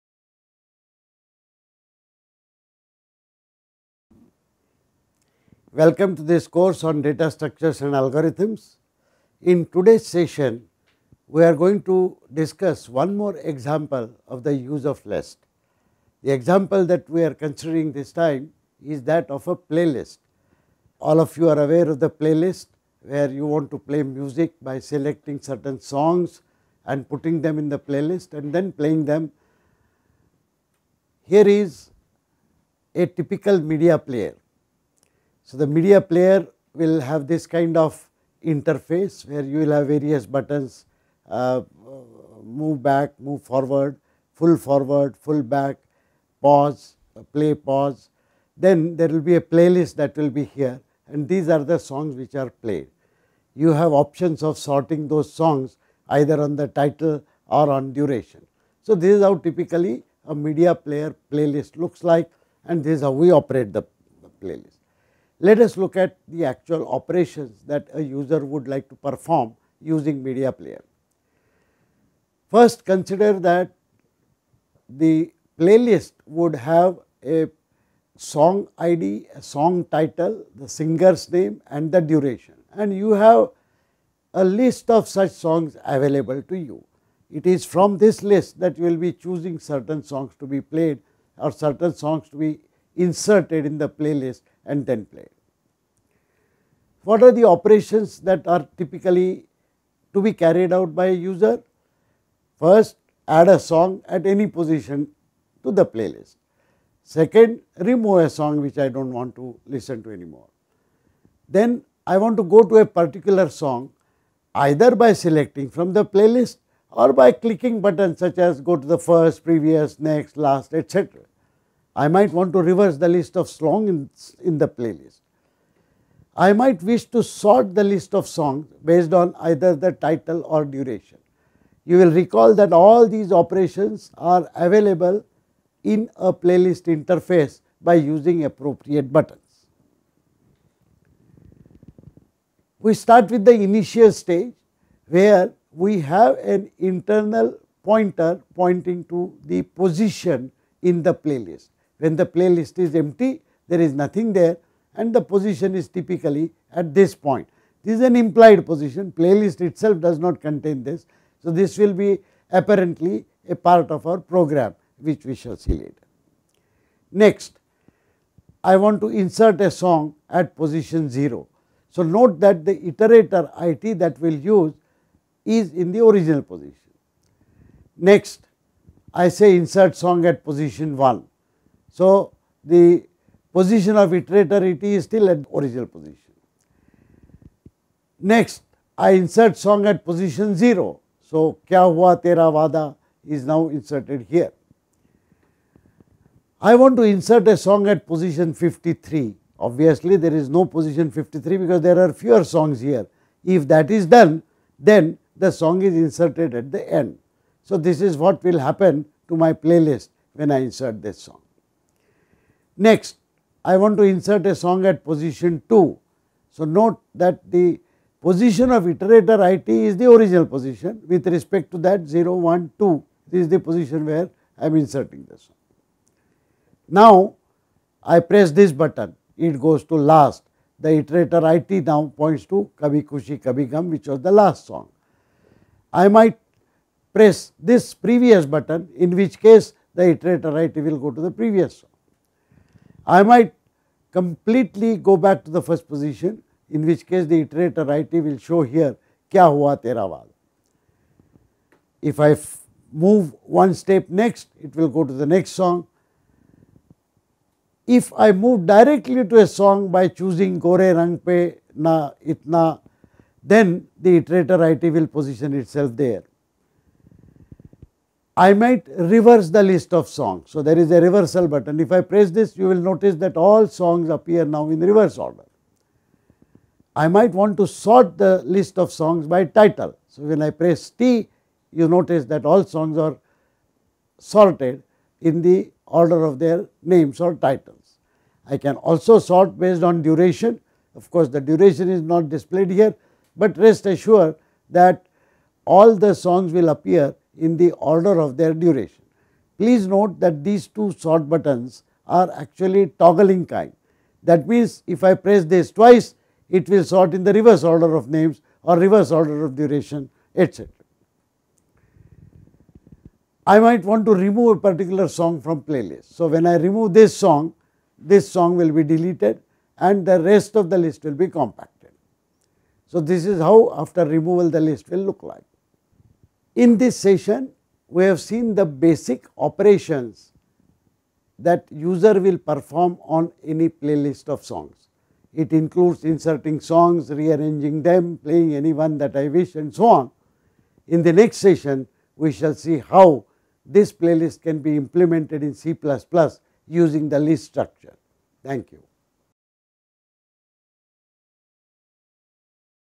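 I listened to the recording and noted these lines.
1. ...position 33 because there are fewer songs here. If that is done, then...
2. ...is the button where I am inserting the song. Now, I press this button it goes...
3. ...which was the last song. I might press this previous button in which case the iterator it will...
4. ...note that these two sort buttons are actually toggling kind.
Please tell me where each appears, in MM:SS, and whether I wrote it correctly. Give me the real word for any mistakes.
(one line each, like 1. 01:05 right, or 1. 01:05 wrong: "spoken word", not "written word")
1. 03:20 wrong: "53", not "33"
2. 03:43 wrong: "position", not "button"
3. 03:53 right
4. 04:59 right.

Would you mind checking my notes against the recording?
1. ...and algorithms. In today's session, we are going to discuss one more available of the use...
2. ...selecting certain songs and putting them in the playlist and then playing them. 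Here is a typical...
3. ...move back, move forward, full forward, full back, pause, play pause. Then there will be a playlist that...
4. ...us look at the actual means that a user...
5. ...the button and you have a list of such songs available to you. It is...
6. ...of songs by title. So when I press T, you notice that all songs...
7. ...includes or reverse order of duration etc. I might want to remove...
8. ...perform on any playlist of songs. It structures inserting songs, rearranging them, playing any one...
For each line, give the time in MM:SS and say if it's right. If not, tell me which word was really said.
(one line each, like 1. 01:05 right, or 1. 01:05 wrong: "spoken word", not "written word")
1. 00:07 wrong: "example", not "available"
2. 00:24 right
3. 00:42 right
4. 01:05 wrong: "operations", not "means"
5. 01:21 wrong: "duration", not "button"
6. 04:38 right
7. 05:08 wrong: "names", not "includes"
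8. 05:32 wrong: "includes", not "structures".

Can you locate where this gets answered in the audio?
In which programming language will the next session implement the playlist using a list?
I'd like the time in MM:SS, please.
05:45.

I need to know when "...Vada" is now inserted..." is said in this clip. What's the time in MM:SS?
03:12.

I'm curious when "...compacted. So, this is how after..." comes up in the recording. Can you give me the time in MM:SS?
05:21.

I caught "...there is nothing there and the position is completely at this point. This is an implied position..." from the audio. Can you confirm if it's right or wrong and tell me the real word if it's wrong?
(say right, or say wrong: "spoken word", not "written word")
wrong: "typically", not "completely".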